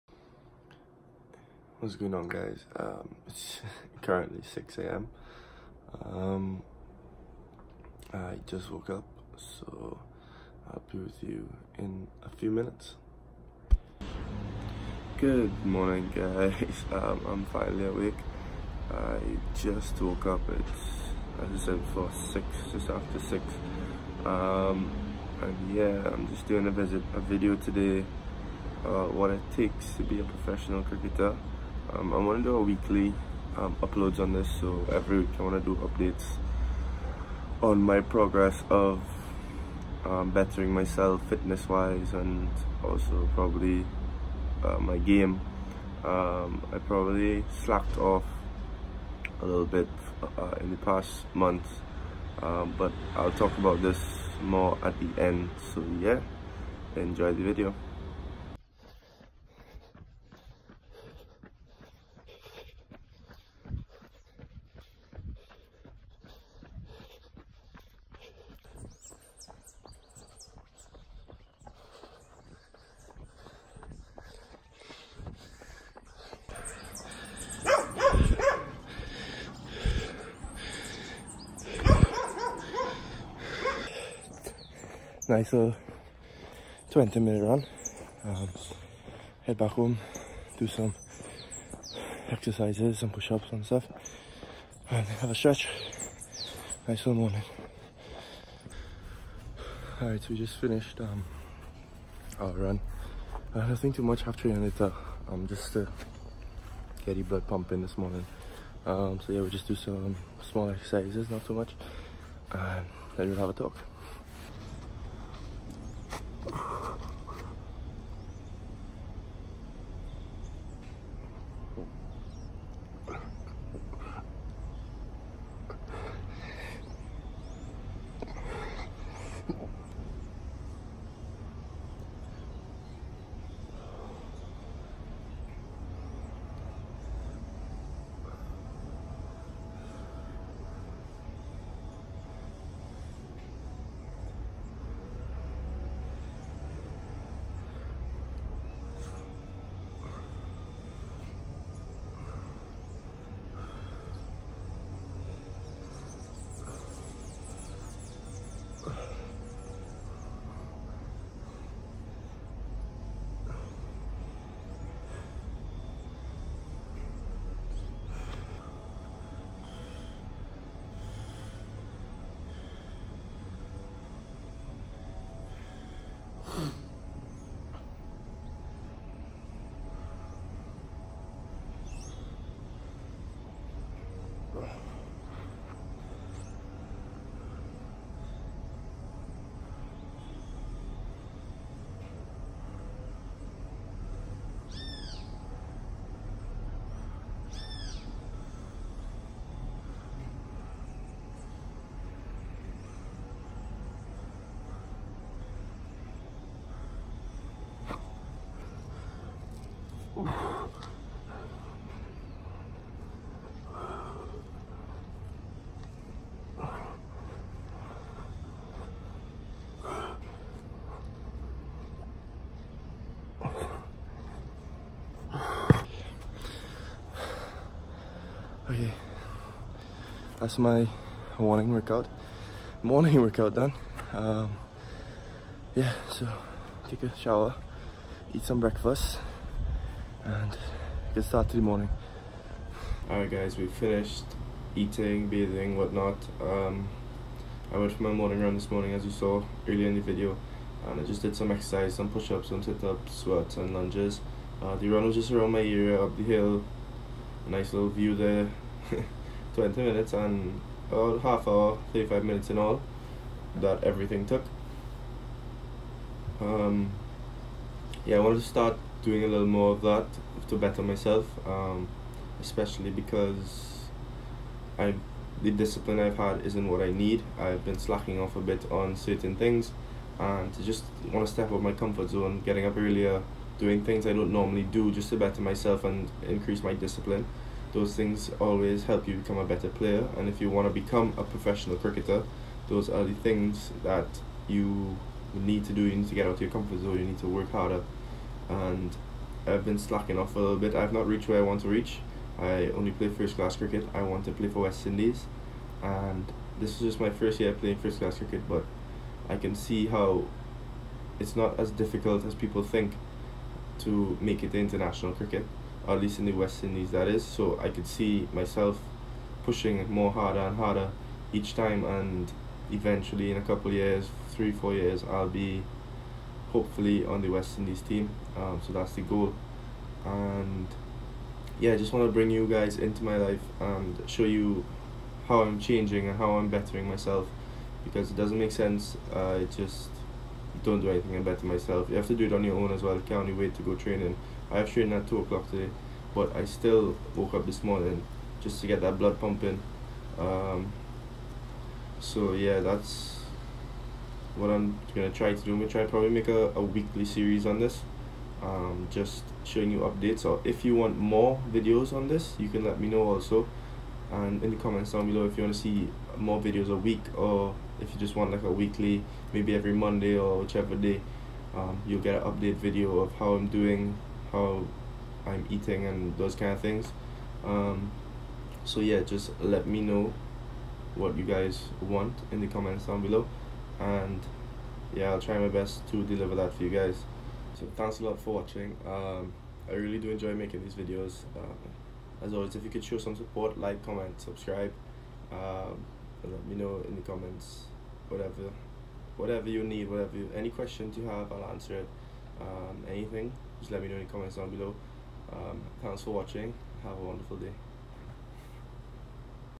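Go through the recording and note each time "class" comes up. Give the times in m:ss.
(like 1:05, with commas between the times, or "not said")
5:03, 5:07.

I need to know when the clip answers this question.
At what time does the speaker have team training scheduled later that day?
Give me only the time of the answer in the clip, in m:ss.
5:45.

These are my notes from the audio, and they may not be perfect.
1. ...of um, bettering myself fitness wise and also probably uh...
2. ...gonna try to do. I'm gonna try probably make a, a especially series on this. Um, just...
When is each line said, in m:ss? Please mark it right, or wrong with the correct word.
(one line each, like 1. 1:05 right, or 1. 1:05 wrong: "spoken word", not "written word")
1. 0:38 right
2. 5:54 wrong: "weekly", not "especially".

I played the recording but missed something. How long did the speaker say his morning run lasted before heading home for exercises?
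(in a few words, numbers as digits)
20 minutes.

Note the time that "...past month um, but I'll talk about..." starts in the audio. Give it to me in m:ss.
0:50.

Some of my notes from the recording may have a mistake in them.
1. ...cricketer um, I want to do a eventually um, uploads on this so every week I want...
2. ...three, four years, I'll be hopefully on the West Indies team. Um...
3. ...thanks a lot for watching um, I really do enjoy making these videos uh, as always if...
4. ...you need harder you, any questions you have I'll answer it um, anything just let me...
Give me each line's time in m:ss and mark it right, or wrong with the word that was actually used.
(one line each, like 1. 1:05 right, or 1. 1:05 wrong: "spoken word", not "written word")
1. 0:30 wrong: "weekly", not "eventually"
2. 5:24 right
3. 6:27 right
4. 6:39 wrong: "whatever", not "harder".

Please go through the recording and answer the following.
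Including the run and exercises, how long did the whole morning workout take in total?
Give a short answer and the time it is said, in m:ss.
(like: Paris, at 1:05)
35 minutes, at 4:21.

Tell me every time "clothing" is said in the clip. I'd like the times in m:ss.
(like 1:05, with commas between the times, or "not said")
not said.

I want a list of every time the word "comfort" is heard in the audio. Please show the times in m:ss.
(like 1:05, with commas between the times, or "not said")
4:41, 4:56.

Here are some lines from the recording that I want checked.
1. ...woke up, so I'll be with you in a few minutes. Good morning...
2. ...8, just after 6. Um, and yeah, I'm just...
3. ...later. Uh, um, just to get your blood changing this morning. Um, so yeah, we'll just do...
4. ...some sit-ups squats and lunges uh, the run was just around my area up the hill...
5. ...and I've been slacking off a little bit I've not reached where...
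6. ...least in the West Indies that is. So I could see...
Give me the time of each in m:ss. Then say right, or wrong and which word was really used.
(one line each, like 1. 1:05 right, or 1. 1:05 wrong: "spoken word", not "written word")
1. 0:08 right
2. 0:22 wrong: "6", not "8"
3. 1:44 wrong: "pumping", not "changing"
4. 4:12 right
5. 4:58 right
6. 5:15 right.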